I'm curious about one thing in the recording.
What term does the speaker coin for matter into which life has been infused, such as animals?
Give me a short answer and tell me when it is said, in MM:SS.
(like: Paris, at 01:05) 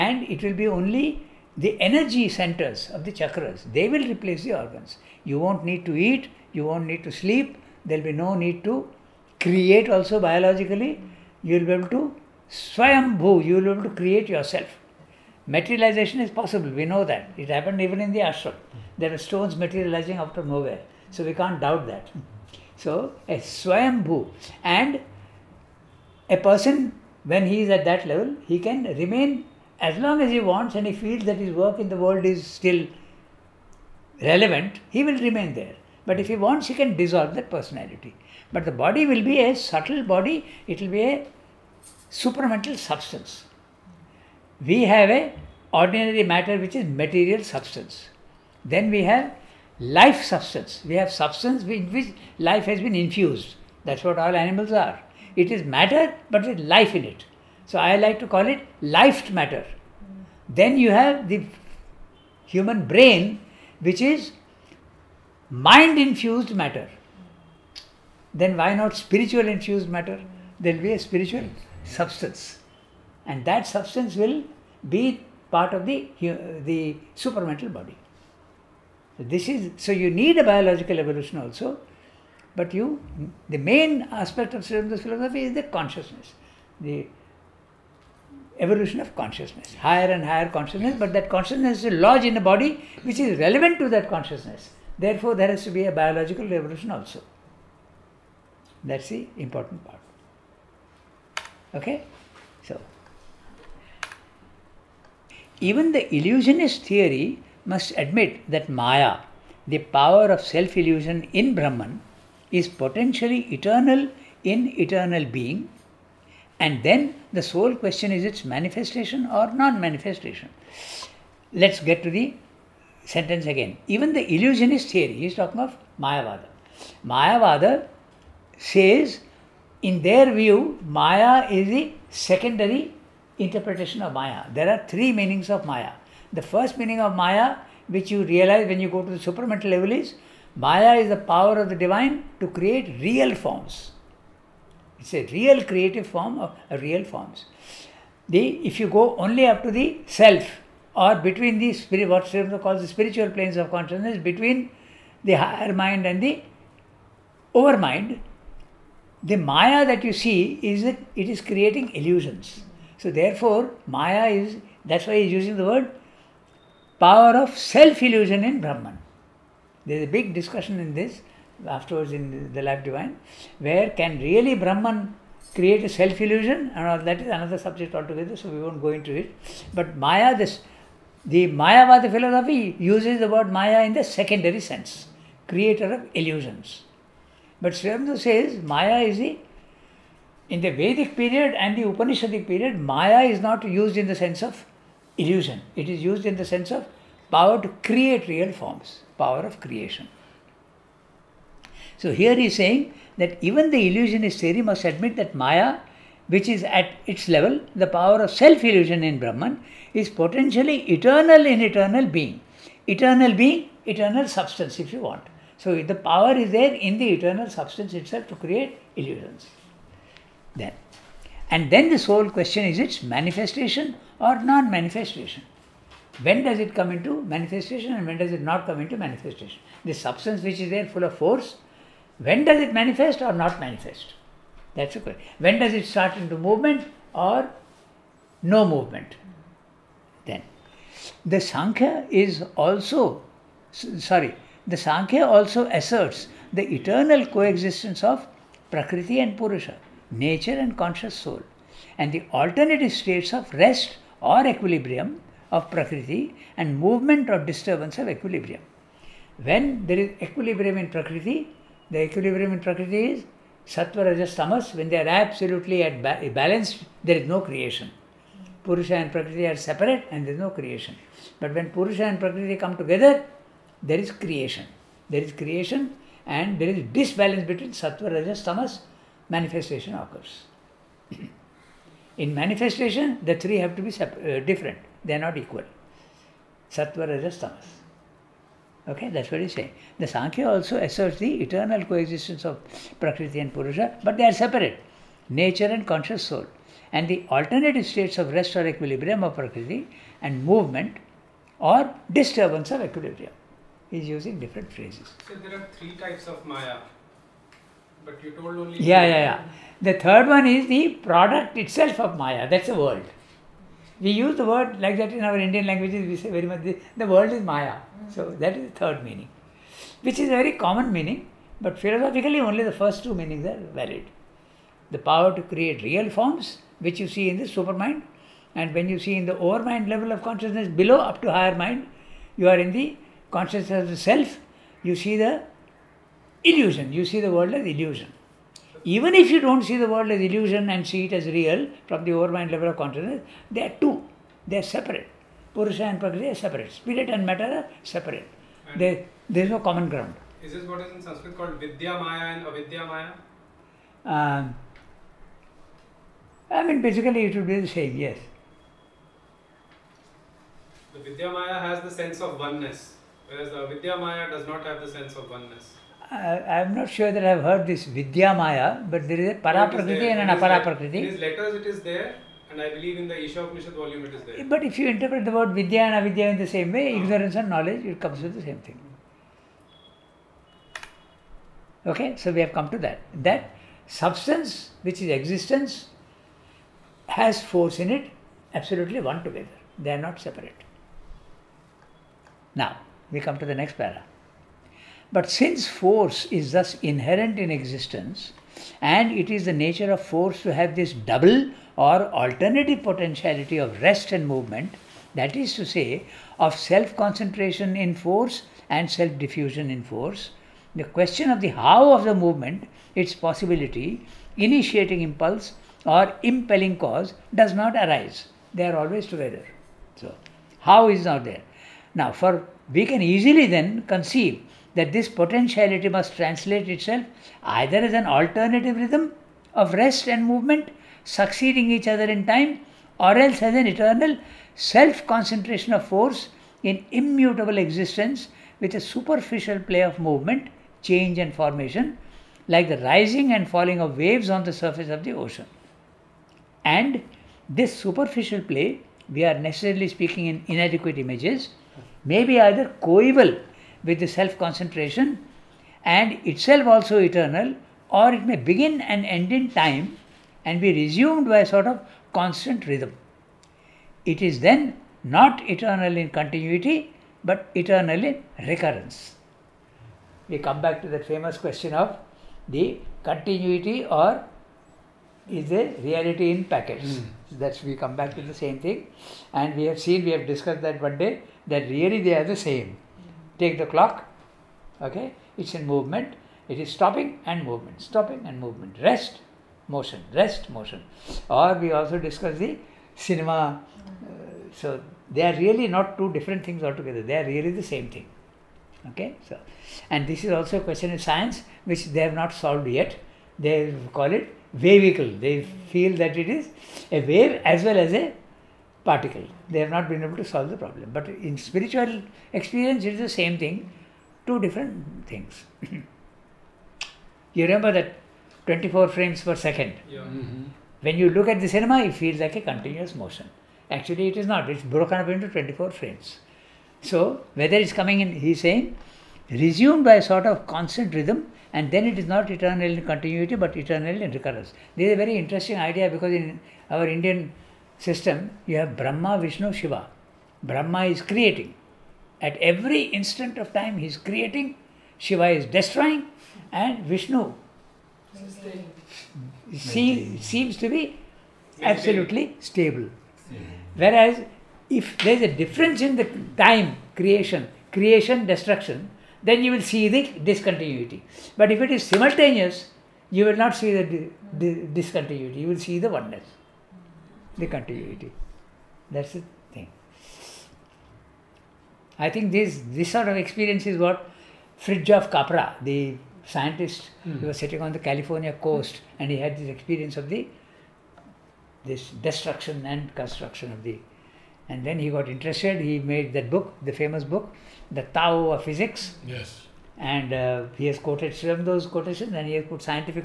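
Life matter, at 00:58.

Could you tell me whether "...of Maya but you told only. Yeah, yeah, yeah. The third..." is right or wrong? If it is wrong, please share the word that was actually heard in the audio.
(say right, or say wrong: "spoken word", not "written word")
right.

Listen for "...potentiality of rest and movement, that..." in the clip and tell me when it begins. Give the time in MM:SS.
06:42.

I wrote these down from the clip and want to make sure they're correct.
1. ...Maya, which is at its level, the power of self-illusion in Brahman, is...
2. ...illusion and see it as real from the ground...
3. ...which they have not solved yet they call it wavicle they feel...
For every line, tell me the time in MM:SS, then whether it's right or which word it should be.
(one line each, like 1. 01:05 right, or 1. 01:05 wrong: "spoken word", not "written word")
1. 03:25 right
2. 05:40 wrong: "overmind", not "ground"
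3. 08:21 right.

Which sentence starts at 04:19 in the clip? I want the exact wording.
When there is equilibrium in Prakriti, the equilibrium in Prakriti is Sattva, Rajas, Tamas.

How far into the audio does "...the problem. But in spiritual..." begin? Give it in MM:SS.
08:30.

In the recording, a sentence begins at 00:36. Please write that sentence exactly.
But if he wants, he can dissolve that personality.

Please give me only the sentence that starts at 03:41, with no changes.
And then this whole question is its manifestation or non manifestation?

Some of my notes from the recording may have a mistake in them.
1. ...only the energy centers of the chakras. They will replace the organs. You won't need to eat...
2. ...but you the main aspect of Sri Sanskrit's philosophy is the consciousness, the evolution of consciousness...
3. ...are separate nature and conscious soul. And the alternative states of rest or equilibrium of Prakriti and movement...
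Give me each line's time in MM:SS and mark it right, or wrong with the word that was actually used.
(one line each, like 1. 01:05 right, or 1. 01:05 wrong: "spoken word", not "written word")
1. 00:00 right
2. 01:22 wrong: "Aurobindo", not "Sanskrit"
3. 04:54 right.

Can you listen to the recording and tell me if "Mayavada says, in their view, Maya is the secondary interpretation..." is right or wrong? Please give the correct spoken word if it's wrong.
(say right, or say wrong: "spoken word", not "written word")
right.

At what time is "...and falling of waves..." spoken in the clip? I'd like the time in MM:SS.
07:23.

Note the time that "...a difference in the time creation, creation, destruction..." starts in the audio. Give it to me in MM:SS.
09:15.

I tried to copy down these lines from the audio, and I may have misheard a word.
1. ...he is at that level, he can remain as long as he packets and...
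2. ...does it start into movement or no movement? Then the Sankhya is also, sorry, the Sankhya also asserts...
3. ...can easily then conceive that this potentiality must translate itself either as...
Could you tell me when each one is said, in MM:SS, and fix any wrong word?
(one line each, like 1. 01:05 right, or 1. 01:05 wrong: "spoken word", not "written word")
1. 00:27 wrong: "wants", not "packets"
2. 03:55 right
3. 07:02 right.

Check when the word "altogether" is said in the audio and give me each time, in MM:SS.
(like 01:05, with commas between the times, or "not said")
02:57, 08:16.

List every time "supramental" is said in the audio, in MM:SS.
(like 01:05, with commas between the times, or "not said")
00:42, 02:19.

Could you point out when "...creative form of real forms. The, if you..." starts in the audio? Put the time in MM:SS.
02:25.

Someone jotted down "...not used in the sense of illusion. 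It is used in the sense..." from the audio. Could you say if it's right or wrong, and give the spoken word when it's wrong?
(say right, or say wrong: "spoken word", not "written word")
right.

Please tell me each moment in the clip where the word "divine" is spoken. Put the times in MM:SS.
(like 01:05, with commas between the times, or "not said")
02:21, 02:52.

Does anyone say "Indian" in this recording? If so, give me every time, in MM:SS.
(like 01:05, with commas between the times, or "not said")
05:15, 08:56.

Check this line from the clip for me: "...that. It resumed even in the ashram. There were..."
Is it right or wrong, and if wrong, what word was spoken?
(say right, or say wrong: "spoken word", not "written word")
wrong: "happened", not "resumed".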